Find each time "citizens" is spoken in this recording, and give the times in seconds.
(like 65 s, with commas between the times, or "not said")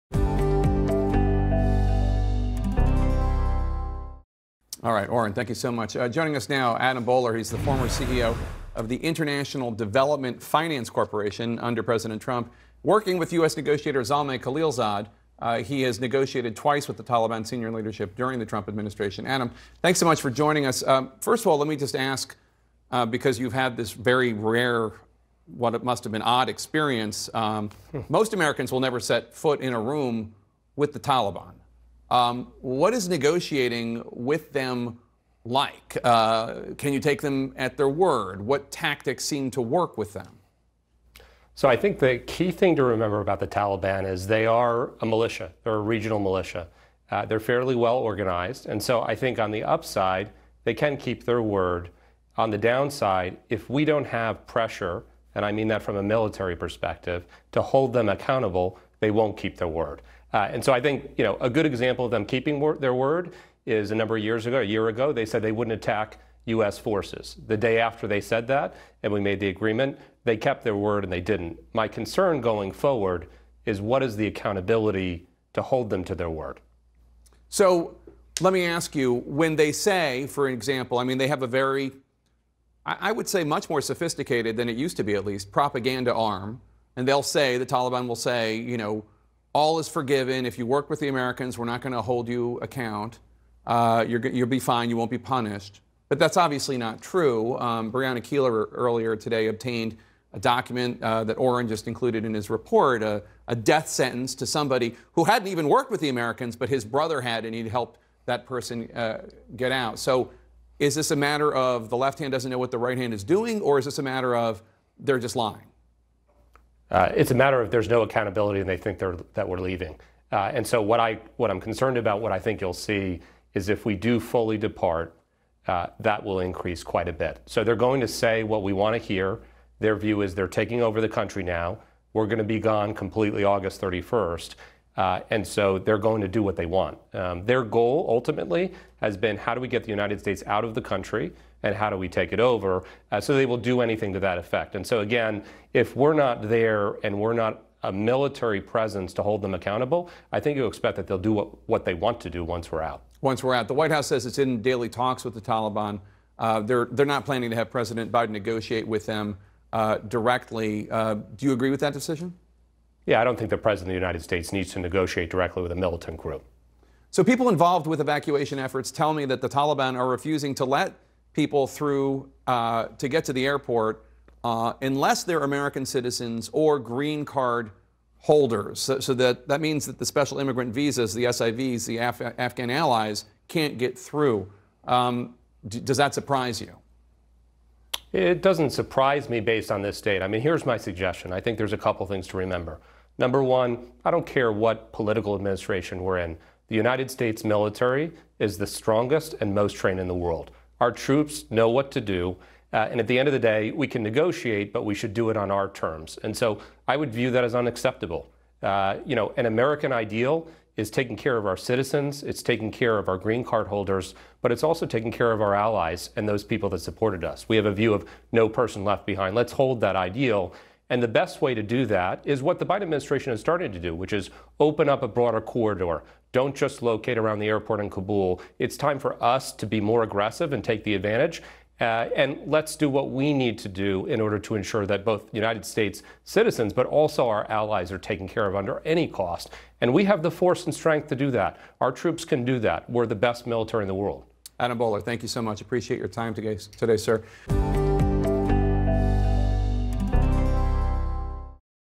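175 s, 211 s, 236 s.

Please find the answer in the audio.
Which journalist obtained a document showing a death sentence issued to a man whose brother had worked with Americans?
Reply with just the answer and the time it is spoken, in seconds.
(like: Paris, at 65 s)
Brianna Keilar, at 97 s.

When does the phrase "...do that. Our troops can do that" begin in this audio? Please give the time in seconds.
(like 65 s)
241 s.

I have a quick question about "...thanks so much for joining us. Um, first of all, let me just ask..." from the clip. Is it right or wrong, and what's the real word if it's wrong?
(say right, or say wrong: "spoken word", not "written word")
right.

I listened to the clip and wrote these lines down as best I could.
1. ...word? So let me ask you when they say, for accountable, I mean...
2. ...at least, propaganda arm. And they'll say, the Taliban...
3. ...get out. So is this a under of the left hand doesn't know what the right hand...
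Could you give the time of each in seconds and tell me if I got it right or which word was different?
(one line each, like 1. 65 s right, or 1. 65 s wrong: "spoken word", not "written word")
1. 76 s wrong: "example", not "accountable"
2. 85 s right
3. 109 s wrong: "matter", not "under".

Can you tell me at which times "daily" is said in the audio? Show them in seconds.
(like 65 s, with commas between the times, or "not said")
154 s.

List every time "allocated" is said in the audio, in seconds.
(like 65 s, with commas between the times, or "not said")
not said.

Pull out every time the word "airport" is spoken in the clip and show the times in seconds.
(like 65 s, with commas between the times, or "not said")
173 s, 227 s.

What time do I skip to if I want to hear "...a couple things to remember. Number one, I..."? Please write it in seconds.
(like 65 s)
191 s.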